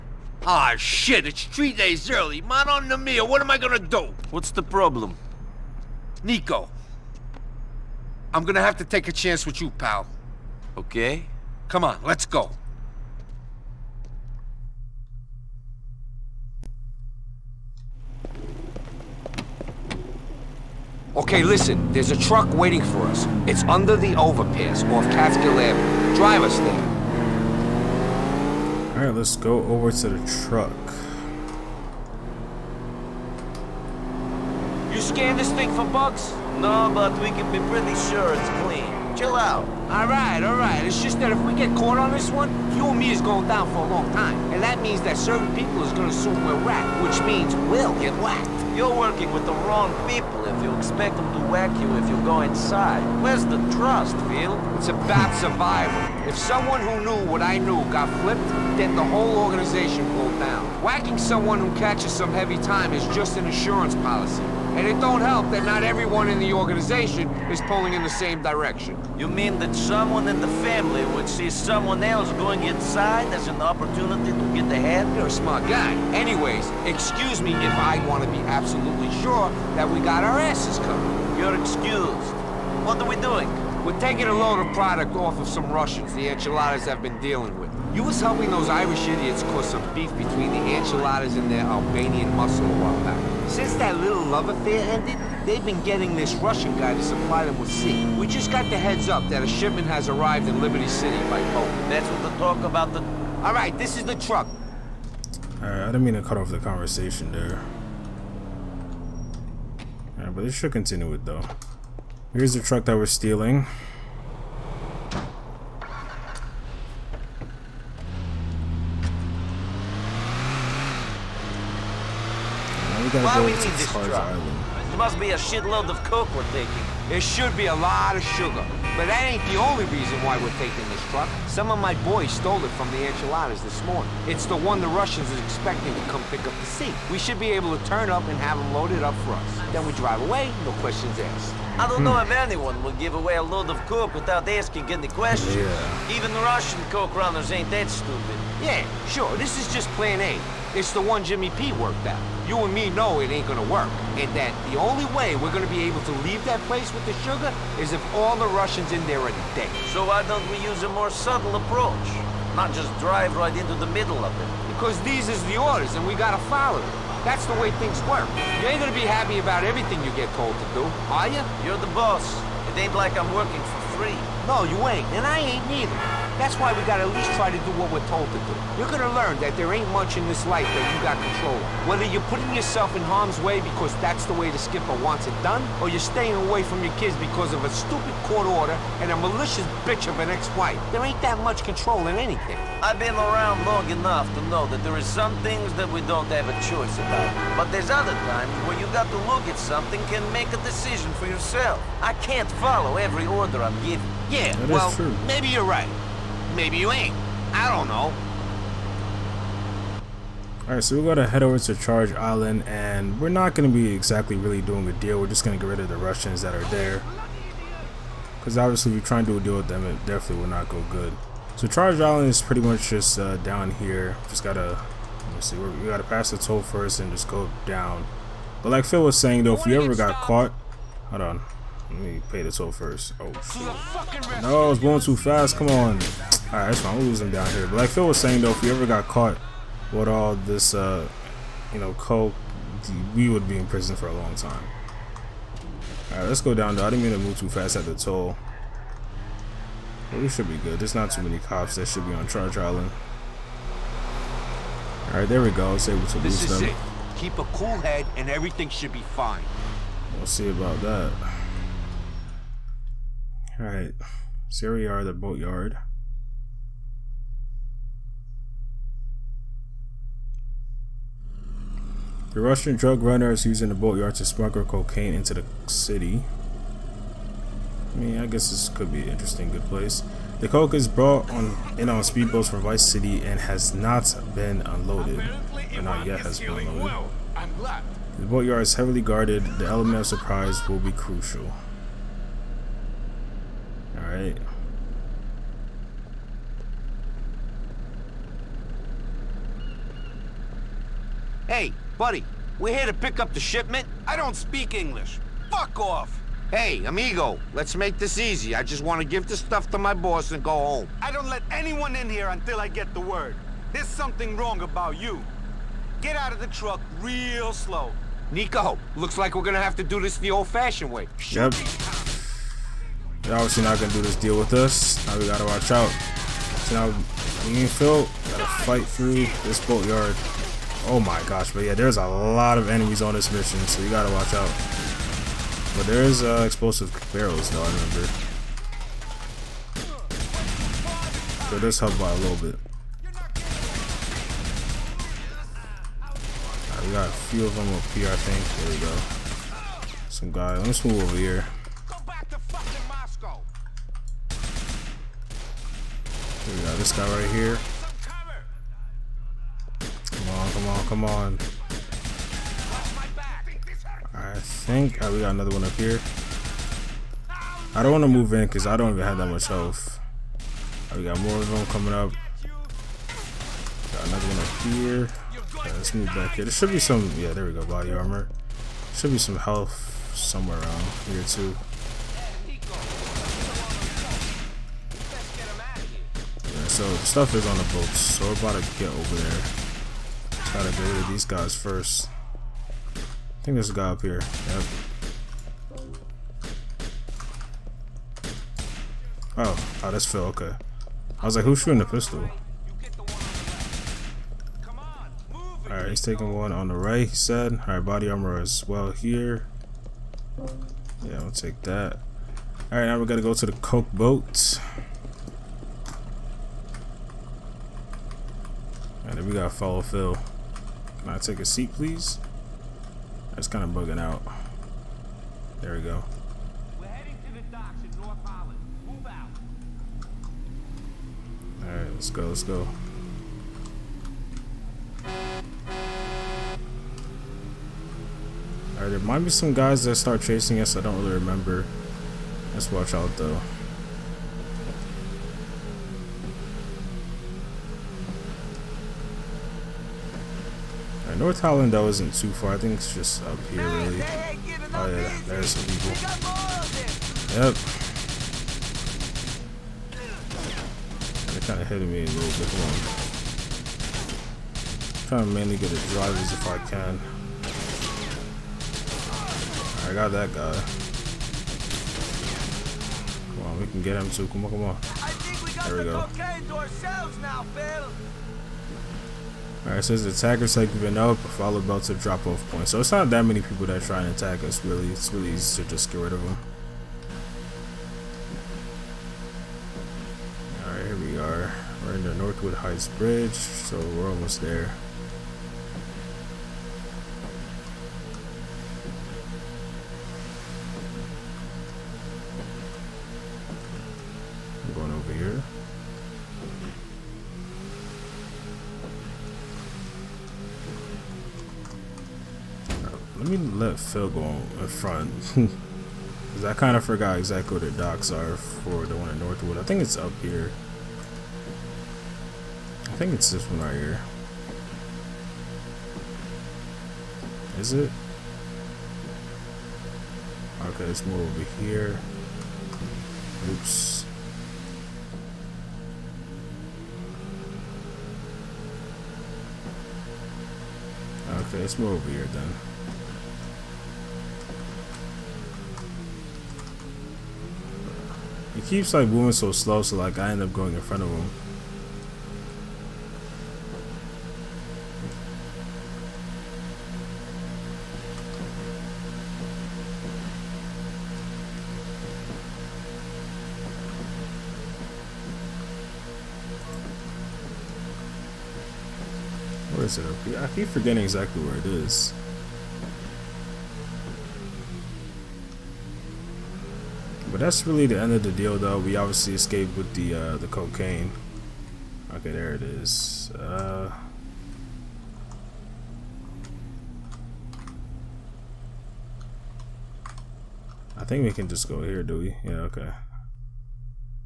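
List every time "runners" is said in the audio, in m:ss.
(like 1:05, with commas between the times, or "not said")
2:27, 4:33.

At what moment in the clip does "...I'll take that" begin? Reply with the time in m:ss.
6:51.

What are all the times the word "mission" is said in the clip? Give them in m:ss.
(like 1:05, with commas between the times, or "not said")
5:33.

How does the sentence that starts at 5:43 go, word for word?
Right, we got a few of them up here, I think.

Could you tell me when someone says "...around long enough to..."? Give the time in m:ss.
3:13.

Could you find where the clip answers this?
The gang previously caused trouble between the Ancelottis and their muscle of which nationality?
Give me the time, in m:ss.
1:31.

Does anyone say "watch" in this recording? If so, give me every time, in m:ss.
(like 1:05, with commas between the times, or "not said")
5:25, 5:34, 7:22.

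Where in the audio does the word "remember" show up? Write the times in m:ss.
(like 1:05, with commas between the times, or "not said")
5:37, 7:21.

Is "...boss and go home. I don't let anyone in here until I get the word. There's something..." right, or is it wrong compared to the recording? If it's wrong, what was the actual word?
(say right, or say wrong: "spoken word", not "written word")
right.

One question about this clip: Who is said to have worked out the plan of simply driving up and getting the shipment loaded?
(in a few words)
Jimmy P.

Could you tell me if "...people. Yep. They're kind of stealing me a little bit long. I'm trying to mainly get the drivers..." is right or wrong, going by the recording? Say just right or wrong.
wrong.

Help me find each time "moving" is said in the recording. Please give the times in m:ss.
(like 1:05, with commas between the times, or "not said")
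9:09.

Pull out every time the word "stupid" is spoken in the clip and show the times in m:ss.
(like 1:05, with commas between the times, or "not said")
2:27, 3:07.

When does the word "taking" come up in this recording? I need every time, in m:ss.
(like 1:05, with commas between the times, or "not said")
1:23, 2:06, 2:10, 6:46.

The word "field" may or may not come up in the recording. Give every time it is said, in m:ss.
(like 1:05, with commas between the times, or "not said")
8:33.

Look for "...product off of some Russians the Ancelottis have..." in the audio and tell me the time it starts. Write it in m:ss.
1:24.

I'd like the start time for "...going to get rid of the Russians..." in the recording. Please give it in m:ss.
3:35.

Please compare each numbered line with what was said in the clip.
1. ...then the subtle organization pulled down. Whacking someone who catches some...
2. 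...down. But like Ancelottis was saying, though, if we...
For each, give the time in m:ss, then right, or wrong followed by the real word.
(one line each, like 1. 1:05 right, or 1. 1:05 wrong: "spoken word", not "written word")
1. 0:58 wrong: "whole", not "subtle"
2. 3:47 wrong: "Phil", not "Ancelottis".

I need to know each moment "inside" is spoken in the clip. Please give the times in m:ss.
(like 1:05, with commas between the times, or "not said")
0:52, 1:12.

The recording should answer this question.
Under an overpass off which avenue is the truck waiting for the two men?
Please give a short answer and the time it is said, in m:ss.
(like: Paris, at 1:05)
Catskill Avenue, at 0:25.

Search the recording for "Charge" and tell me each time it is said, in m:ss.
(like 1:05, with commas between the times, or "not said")
3:31, 3:41, 4:12.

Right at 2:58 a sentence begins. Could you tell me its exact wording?
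You're gonna learn that there ain't much in this life that you got control of.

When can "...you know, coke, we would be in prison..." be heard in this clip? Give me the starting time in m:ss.
4:01.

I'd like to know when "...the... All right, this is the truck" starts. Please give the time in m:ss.
1:42.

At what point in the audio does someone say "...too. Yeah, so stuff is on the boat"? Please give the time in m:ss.
6:21.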